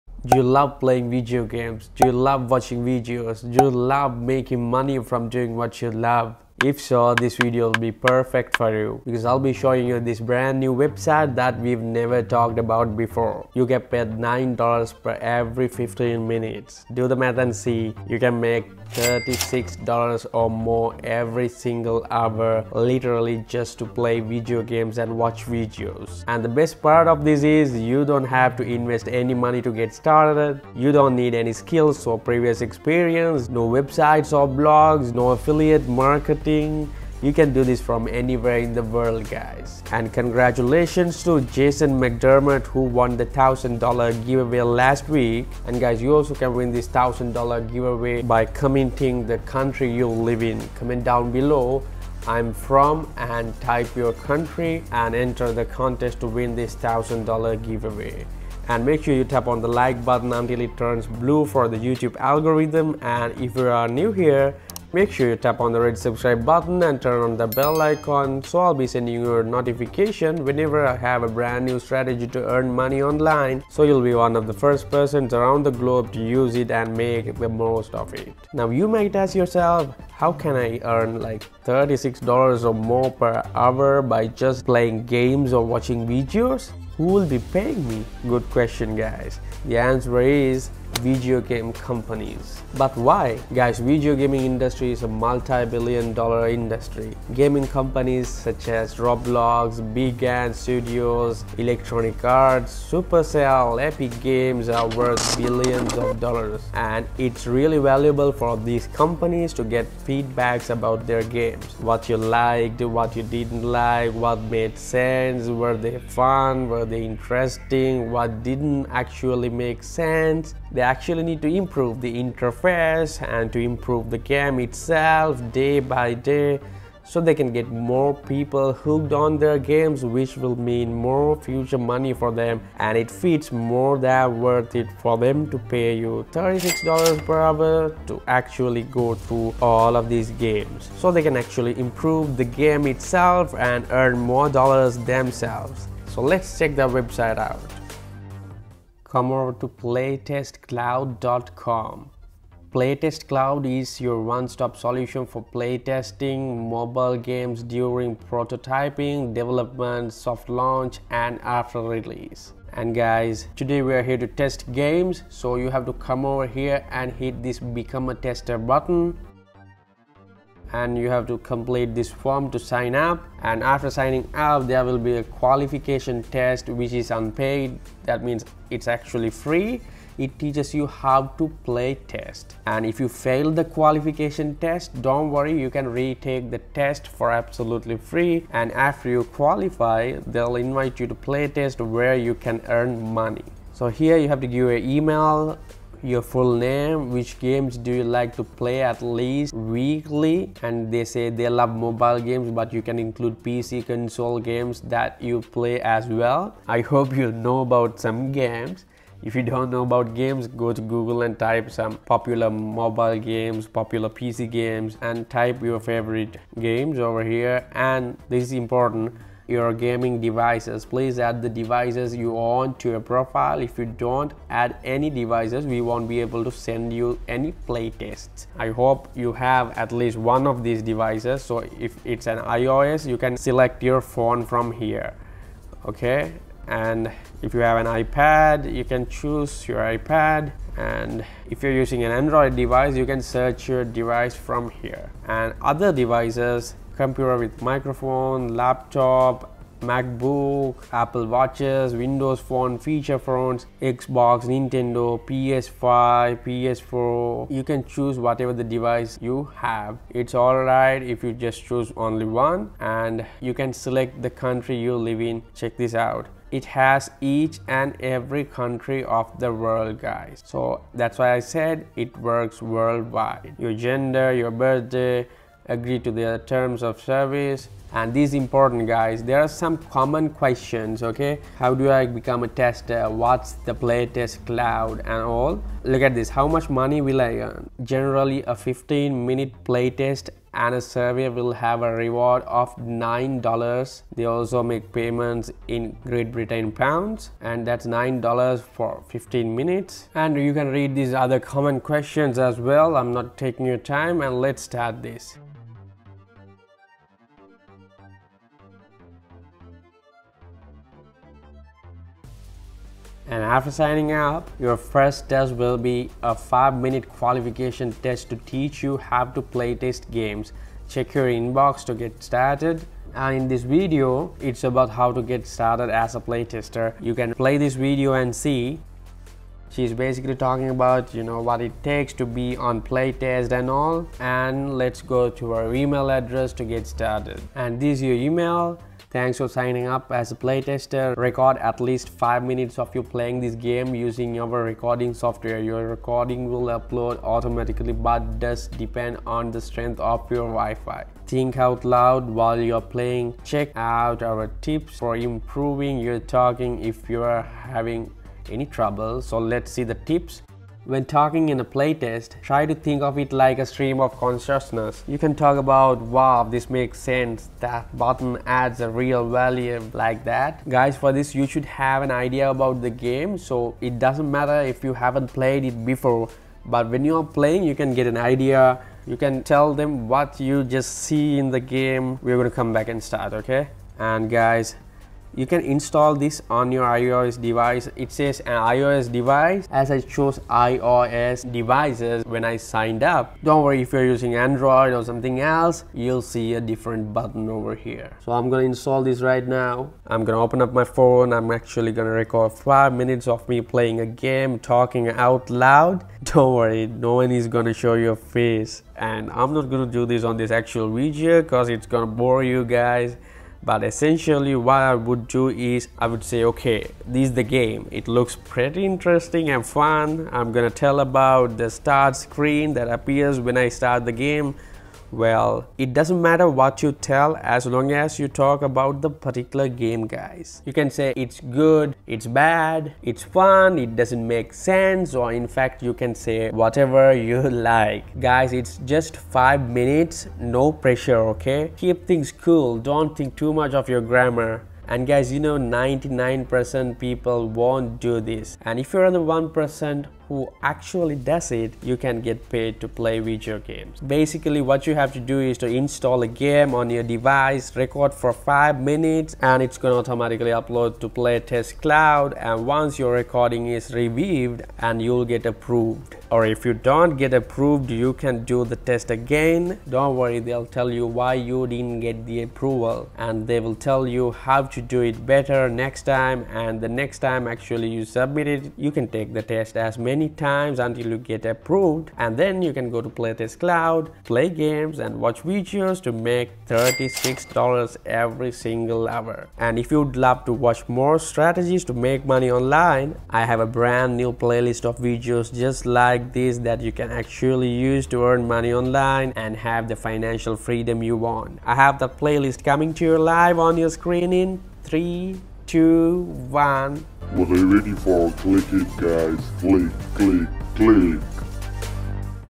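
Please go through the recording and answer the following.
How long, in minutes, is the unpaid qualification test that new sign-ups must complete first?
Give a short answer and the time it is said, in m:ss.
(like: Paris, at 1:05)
5, at 5:16.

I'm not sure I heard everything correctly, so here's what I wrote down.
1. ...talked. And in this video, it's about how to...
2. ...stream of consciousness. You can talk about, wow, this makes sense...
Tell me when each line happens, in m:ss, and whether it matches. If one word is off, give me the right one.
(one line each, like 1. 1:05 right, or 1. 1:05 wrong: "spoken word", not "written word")
1. 5:22 wrong: "started", not "talked"
2. 6:03 right.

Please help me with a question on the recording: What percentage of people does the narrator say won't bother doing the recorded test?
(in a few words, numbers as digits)
99%.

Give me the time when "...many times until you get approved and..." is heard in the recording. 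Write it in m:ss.
7:59.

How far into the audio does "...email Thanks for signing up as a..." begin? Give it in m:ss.
5:38.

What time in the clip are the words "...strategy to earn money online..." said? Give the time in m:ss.
1:11.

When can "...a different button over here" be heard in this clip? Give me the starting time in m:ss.
6:36.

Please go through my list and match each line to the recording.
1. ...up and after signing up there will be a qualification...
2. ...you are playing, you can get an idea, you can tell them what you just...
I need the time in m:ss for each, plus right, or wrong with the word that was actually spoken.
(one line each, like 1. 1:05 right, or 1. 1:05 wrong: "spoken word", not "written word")
1. 2:52 right
2. 6:17 right.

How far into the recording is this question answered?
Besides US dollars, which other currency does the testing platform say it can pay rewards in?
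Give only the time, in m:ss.
4:56.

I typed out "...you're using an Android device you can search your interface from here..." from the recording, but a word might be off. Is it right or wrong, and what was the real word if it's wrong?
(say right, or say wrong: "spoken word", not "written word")
wrong: "device", not "interface".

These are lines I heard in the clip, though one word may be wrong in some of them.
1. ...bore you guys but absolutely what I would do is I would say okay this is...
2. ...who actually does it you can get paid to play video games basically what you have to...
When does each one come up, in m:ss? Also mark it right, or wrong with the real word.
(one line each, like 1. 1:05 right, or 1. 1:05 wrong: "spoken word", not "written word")
1. 6:52 wrong: "essentially", not "absolutely"
2. 7:30 right.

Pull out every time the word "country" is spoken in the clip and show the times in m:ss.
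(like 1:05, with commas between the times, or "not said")
0:49, 0:54, 4:24, 4:28.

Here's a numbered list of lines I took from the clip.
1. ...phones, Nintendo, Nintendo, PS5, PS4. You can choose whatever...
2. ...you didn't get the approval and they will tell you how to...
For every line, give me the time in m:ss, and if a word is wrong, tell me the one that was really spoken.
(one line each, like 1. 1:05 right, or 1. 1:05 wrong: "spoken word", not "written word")
1. 4:13 wrong: "Xbox", not "Nintendo"
2. 7:51 right.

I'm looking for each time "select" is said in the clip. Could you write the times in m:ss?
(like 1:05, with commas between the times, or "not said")
3:53, 4:23.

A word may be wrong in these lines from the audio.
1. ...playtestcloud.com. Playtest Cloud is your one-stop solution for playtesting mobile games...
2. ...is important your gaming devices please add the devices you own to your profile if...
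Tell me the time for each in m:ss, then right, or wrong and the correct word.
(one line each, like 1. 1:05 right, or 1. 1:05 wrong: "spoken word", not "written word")
1. 2:29 right
2. 3:38 right.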